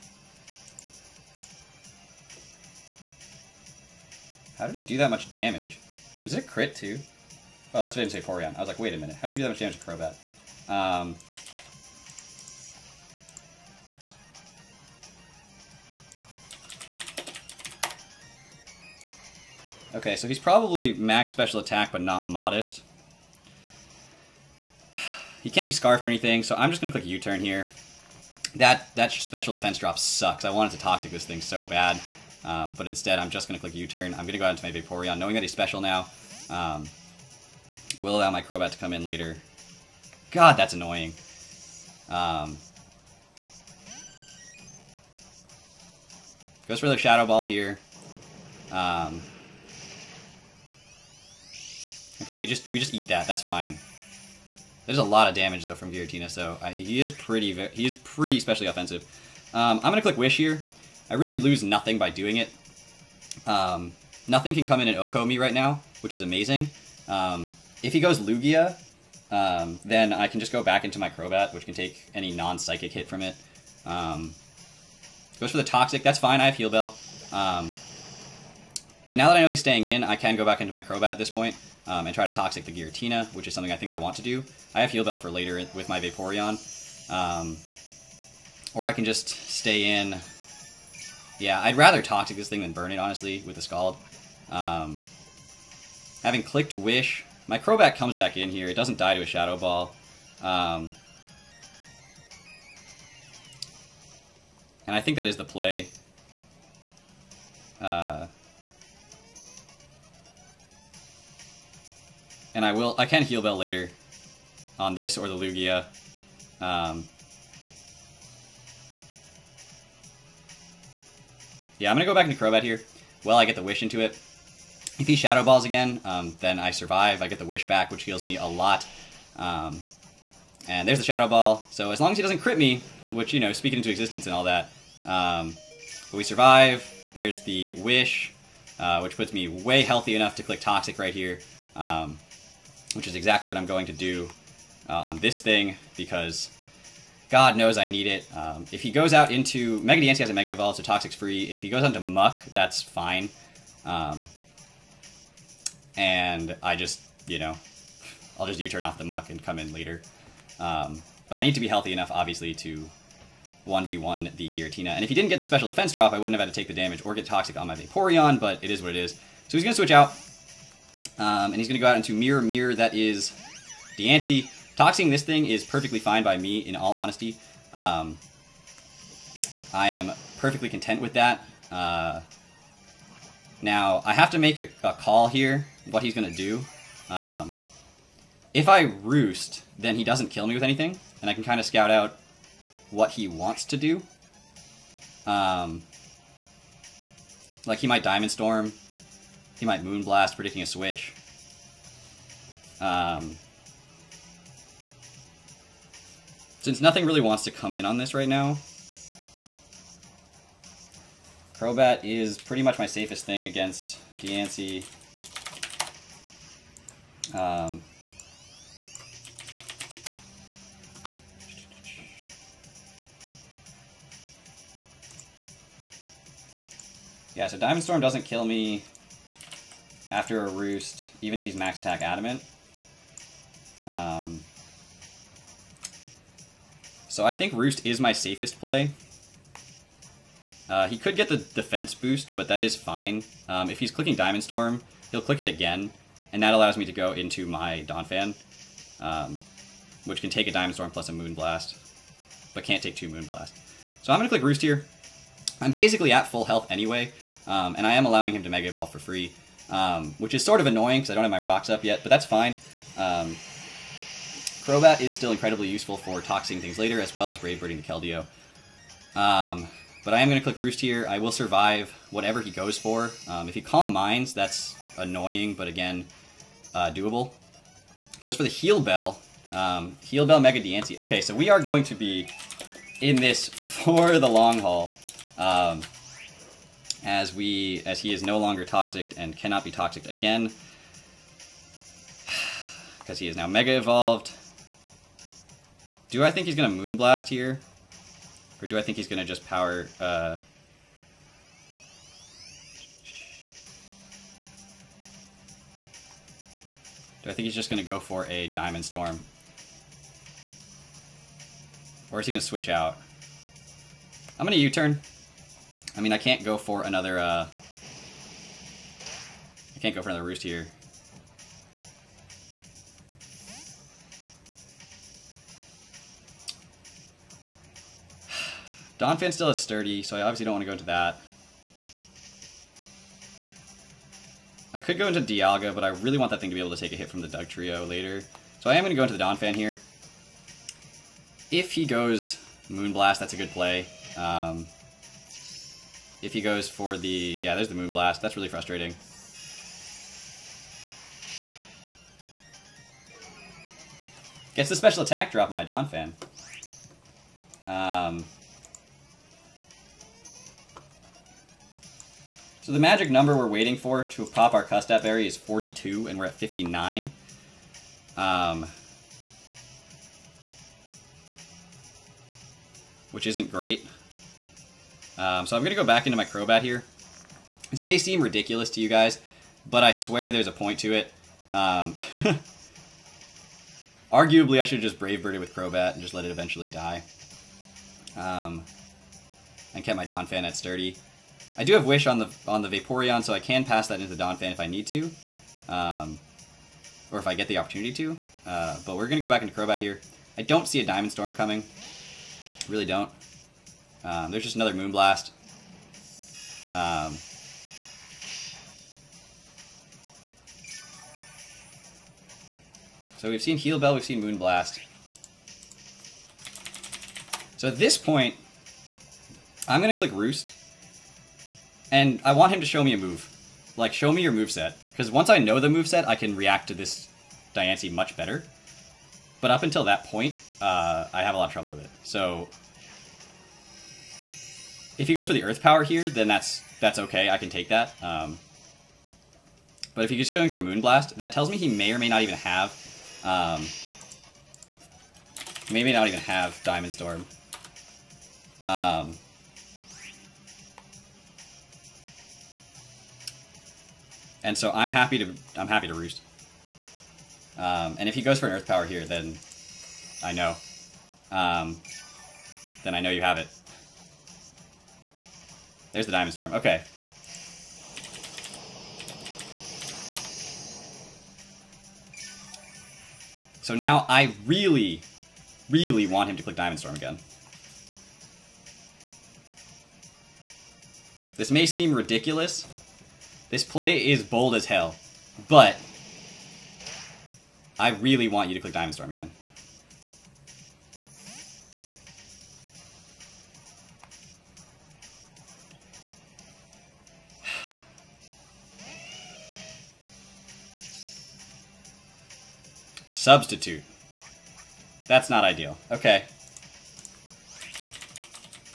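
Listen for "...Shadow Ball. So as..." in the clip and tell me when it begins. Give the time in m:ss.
2:11.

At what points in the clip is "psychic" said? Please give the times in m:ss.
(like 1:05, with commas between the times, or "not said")
1:12.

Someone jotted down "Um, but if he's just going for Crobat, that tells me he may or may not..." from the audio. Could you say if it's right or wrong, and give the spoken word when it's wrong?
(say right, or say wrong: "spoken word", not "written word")
wrong: "Moonblast", not "Crobat".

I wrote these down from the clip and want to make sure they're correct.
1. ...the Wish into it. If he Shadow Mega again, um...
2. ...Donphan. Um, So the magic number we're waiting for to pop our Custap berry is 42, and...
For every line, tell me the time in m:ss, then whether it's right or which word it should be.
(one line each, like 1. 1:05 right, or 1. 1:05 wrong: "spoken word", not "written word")
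1. 2:03 wrong: "Balls", not "Mega"
2. 5:55 right.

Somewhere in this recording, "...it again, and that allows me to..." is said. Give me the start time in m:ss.
4:05.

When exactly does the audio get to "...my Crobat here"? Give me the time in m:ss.
6:16.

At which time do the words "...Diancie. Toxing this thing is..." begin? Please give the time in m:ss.
2:53.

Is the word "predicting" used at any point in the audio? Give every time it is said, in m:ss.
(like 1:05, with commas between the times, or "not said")
3:20.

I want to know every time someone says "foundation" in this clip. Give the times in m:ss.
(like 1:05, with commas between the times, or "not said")
not said.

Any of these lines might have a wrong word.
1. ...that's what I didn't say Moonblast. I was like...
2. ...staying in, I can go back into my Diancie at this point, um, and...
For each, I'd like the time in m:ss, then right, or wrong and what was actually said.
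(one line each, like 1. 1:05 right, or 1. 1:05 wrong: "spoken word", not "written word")
1. 0:07 wrong: "Porygon", not "Moonblast"
2. 1:19 wrong: "Crobat", not "Diancie".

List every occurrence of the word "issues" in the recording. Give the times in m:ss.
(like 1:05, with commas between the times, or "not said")
not said.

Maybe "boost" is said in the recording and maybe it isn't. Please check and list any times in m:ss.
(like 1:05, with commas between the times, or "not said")
4:01.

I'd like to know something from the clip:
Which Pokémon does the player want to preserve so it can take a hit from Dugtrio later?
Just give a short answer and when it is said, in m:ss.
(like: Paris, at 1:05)
Dialga, at 5:35.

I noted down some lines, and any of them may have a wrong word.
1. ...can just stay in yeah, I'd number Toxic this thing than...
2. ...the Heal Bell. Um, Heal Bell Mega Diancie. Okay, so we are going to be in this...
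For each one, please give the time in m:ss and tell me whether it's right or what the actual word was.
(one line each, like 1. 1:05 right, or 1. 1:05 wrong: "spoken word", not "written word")
1. 1:28 wrong: "rather", not "number"
2. 4:38 right.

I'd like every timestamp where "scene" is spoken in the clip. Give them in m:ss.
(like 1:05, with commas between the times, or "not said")
not said.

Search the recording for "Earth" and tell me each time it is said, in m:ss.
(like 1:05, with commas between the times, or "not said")
7:15, 7:38.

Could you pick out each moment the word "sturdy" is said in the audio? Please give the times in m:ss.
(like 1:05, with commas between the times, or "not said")
5:29, 6:30.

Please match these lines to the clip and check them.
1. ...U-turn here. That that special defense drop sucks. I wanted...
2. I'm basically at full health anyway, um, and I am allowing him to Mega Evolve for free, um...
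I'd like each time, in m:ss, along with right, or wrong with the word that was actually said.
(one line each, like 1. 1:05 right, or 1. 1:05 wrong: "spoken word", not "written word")
1. 0:27 right
2. 4:15 right.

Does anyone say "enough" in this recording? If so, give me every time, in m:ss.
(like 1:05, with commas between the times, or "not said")
2:20, 2:41.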